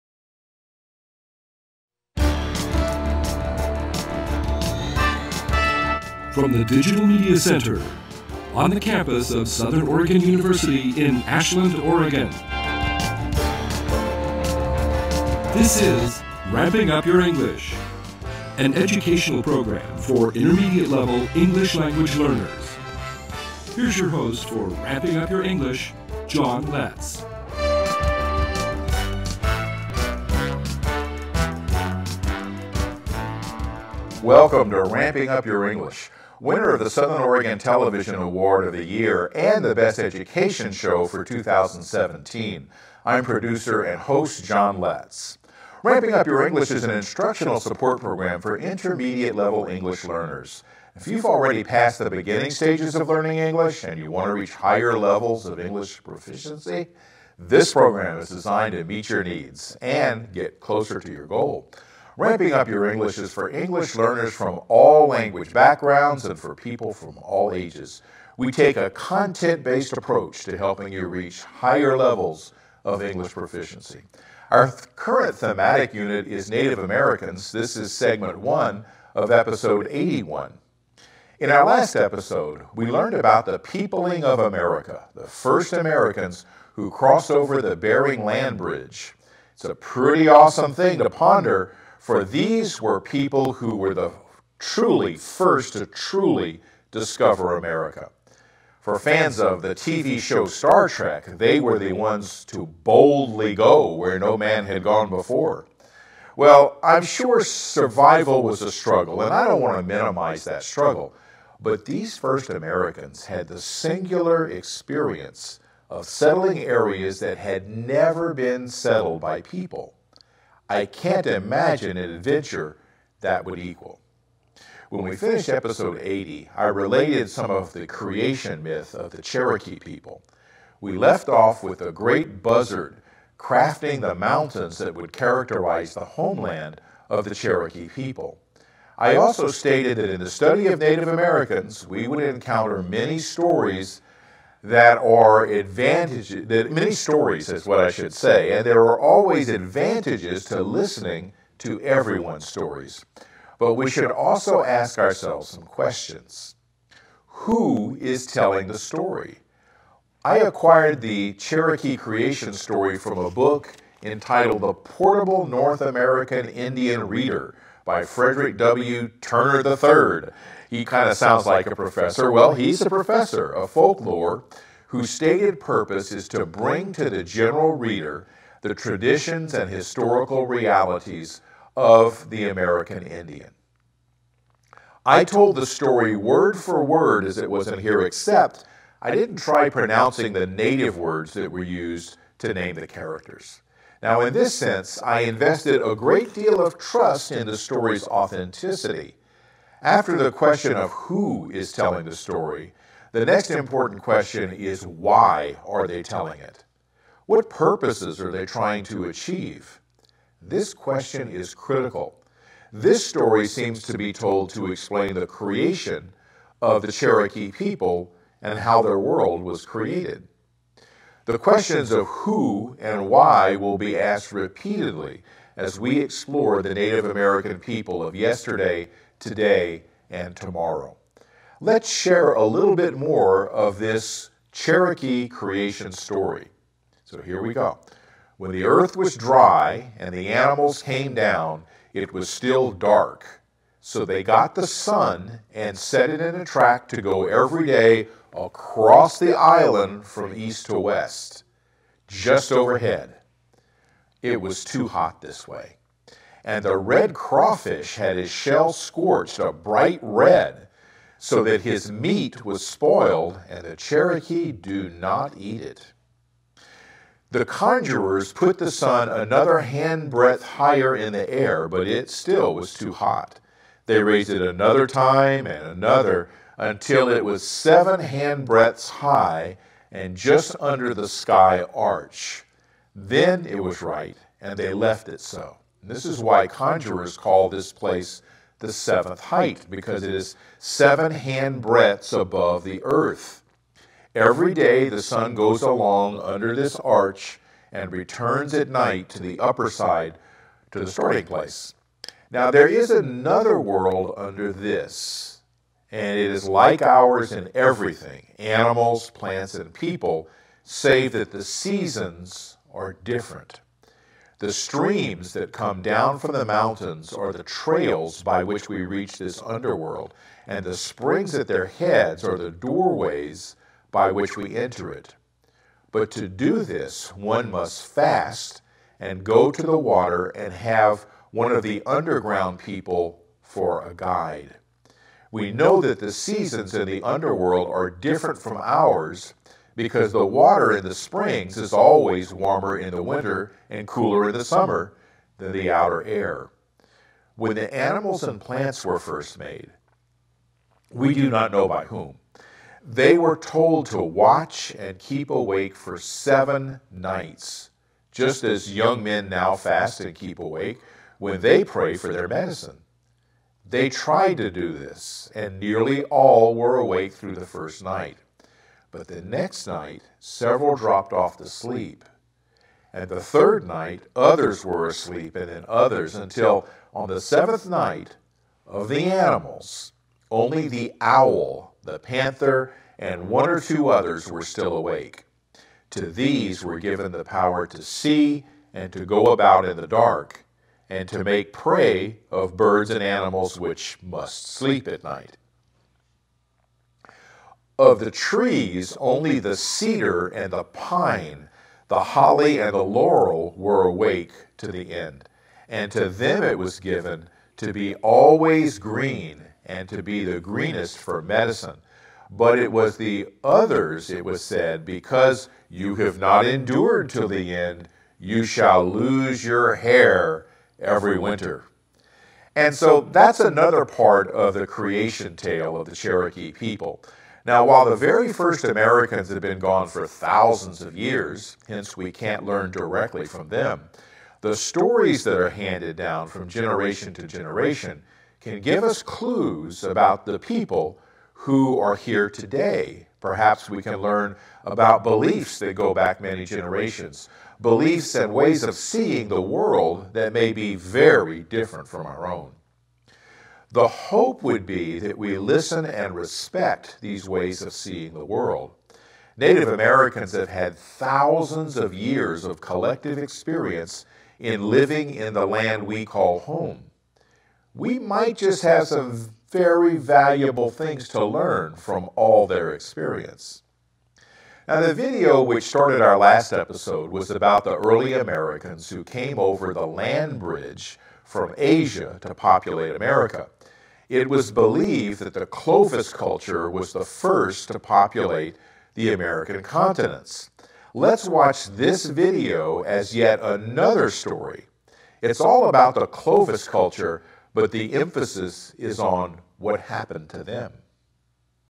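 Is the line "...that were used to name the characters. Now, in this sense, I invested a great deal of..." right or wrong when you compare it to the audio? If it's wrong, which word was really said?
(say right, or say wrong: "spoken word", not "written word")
right.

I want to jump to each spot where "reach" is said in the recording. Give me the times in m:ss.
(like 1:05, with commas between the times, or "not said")
0:54, 1:11, 5:18.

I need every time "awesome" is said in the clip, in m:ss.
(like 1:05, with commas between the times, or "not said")
1:30.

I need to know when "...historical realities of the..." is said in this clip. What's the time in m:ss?
2:59.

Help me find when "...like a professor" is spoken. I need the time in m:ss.
2:51.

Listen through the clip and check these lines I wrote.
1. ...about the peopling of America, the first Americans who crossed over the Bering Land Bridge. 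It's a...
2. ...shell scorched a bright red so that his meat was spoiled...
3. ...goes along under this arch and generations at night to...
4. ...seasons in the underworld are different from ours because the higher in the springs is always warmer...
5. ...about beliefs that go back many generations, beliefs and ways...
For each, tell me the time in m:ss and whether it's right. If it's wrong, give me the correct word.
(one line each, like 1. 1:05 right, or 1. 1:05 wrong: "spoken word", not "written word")
1. 1:23 right
2. 4:18 right
3. 4:55 wrong: "returns", not "generations"
4. 5:36 wrong: "water", not "higher"
5. 7:24 right.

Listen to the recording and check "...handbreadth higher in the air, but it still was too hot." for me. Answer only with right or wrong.
right.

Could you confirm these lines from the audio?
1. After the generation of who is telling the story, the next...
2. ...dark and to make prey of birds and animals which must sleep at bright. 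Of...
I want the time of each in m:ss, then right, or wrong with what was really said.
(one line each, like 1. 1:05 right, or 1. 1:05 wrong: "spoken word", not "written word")
1. 3:19 wrong: "question", not "generation"
2. 6:29 wrong: "night", not "bright".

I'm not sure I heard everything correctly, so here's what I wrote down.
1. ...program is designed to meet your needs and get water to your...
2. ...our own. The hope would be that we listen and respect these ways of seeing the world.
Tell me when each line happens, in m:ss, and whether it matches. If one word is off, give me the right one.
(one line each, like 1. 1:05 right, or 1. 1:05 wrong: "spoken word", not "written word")
1. 0:57 wrong: "closer", not "water"
2. 7:32 right.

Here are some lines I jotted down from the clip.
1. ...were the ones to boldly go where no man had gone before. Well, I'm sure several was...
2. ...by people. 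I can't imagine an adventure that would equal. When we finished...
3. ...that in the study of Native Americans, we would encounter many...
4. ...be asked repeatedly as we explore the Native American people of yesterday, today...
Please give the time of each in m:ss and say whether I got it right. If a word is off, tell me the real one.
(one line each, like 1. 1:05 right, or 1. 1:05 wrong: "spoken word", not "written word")
1. 1:41 wrong: "survival", not "several"
2. 1:59 right
3. 2:19 right
4. 3:43 right.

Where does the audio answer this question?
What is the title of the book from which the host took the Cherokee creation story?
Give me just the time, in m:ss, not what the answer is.
2:44.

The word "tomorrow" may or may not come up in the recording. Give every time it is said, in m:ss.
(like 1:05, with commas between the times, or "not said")
3:50.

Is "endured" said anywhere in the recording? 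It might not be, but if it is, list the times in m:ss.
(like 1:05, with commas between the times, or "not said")
6:56.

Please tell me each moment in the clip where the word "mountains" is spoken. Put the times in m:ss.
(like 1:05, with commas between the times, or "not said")
2:14, 5:16.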